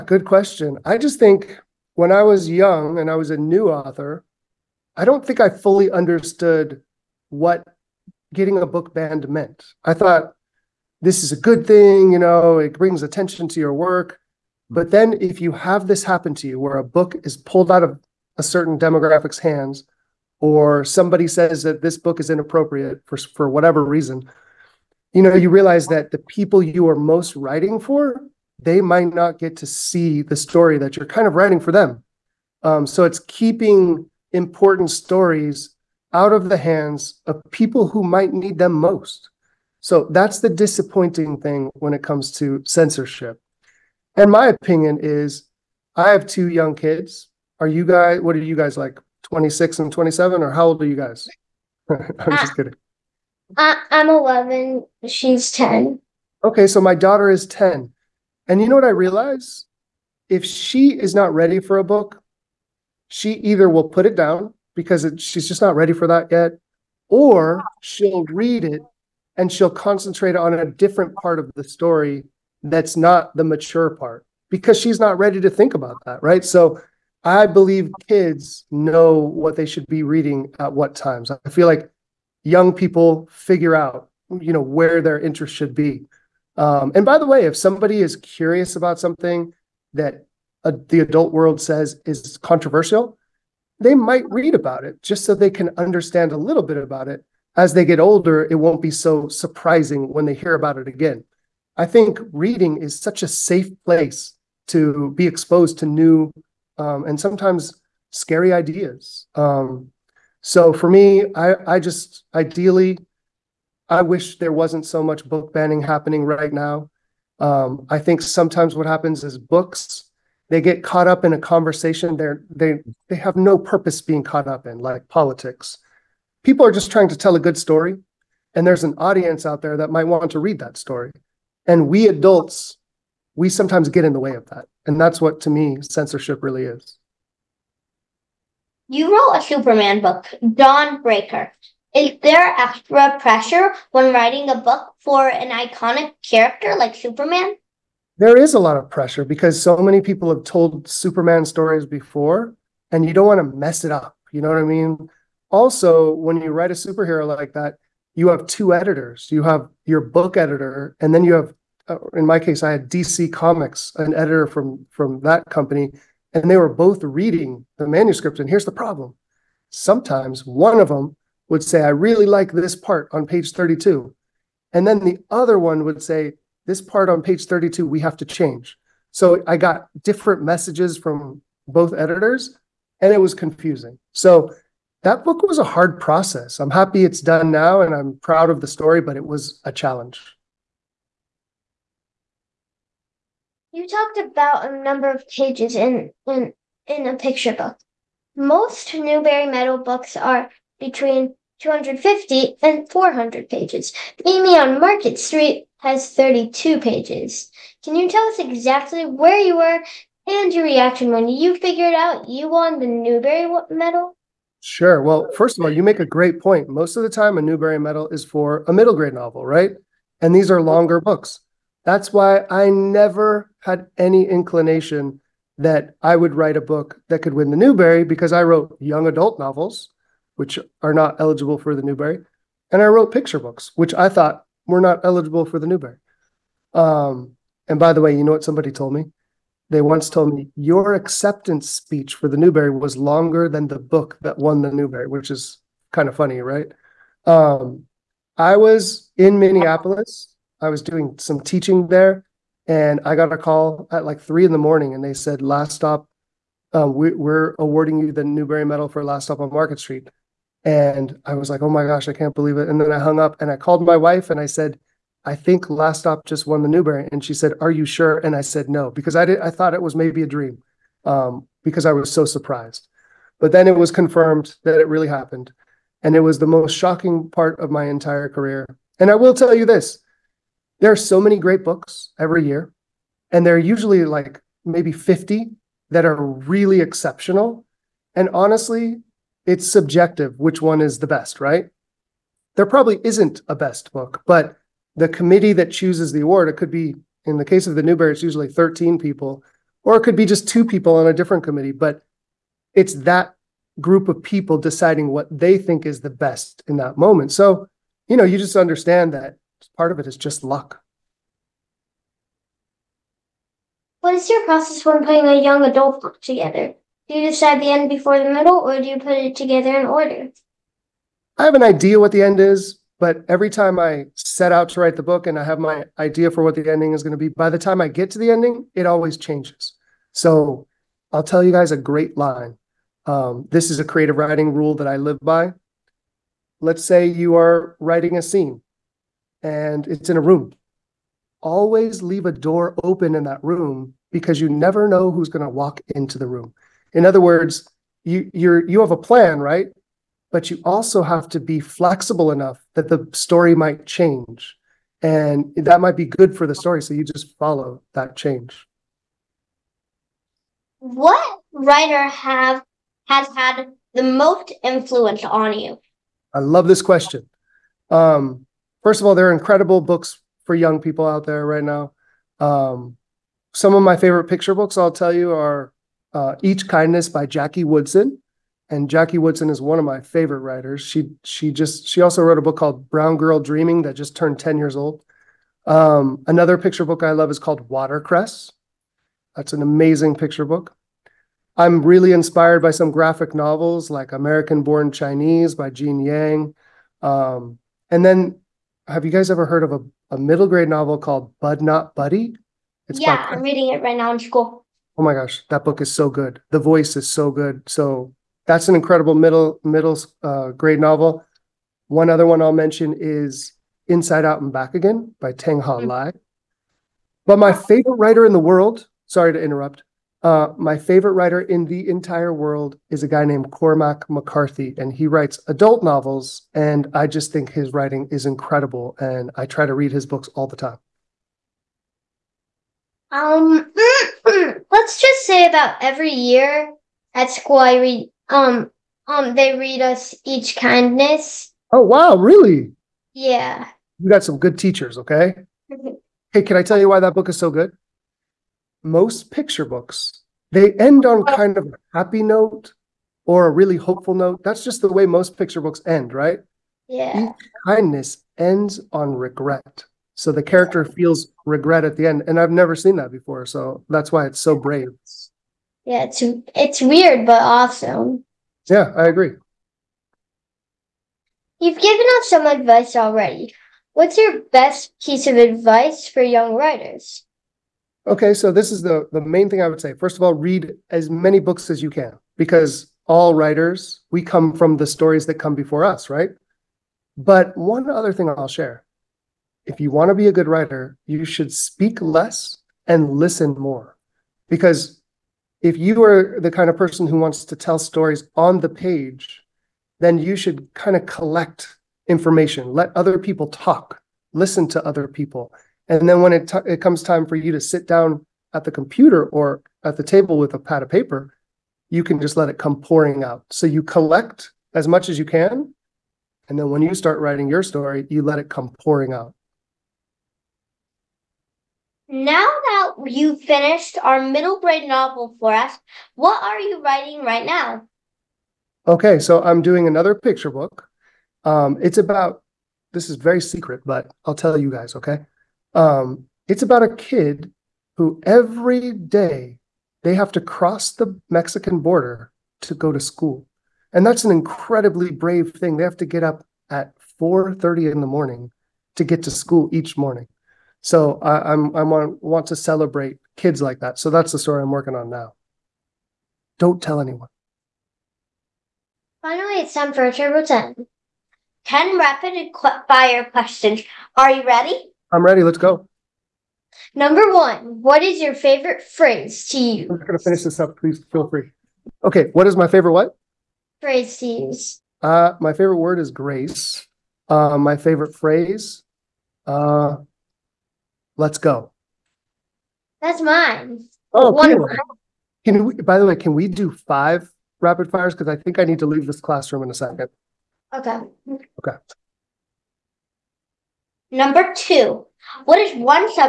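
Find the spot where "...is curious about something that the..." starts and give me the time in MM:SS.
01:28.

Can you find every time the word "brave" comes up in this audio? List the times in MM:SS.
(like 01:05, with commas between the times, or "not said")
07:44, 09:05.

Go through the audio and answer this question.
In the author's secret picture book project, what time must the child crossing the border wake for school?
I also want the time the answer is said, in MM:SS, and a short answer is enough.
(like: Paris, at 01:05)
4:30, at 09:07.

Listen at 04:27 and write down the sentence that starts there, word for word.
And she said, Are you sure?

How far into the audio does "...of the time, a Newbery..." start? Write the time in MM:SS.
03:36.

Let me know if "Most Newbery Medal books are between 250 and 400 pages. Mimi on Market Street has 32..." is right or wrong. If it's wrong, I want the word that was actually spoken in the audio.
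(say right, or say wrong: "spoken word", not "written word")
right.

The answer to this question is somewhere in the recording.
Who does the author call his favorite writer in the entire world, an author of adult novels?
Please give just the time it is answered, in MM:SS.
07:03.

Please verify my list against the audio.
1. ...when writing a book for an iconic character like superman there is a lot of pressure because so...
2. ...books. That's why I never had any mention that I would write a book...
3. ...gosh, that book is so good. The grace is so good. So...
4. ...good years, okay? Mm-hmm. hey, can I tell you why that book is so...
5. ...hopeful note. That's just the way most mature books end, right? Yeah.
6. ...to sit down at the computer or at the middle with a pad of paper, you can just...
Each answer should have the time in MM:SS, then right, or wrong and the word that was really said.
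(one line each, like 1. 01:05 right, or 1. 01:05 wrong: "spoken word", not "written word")
1. 02:23 right
2. 03:41 wrong: "inclination", not "mention"
3. 06:45 wrong: "voice", not "grace"
4. 07:24 wrong: "teachers", not "years"
5. 07:33 wrong: "picture", not "mature"
6. 08:27 wrong: "table", not "middle".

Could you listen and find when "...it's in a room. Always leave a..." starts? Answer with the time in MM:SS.
05:39.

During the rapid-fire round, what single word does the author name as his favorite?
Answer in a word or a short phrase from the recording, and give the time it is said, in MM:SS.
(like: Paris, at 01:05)
Grace, at 09:36.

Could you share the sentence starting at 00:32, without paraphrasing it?
Um, so it's keeping important stories out of the hands of people who might need them most.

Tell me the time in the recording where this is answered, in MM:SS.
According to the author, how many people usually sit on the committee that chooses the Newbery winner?
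04:58.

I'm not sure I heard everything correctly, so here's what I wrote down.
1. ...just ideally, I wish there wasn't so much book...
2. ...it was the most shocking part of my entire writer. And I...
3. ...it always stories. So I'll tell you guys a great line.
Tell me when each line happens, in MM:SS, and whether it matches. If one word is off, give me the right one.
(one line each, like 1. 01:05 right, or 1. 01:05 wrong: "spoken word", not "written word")
1. 01:51 right
2. 04:36 wrong: "career", not "writer"
3. 05:28 wrong: "changes", not "stories".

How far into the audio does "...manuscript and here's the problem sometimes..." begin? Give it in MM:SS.
02:47.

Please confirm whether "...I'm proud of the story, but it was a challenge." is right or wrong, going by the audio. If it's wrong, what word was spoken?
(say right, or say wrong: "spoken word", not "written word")
right.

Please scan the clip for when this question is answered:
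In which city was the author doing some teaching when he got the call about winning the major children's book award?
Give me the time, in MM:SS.
04:09.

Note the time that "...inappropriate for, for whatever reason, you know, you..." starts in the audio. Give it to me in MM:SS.
00:22.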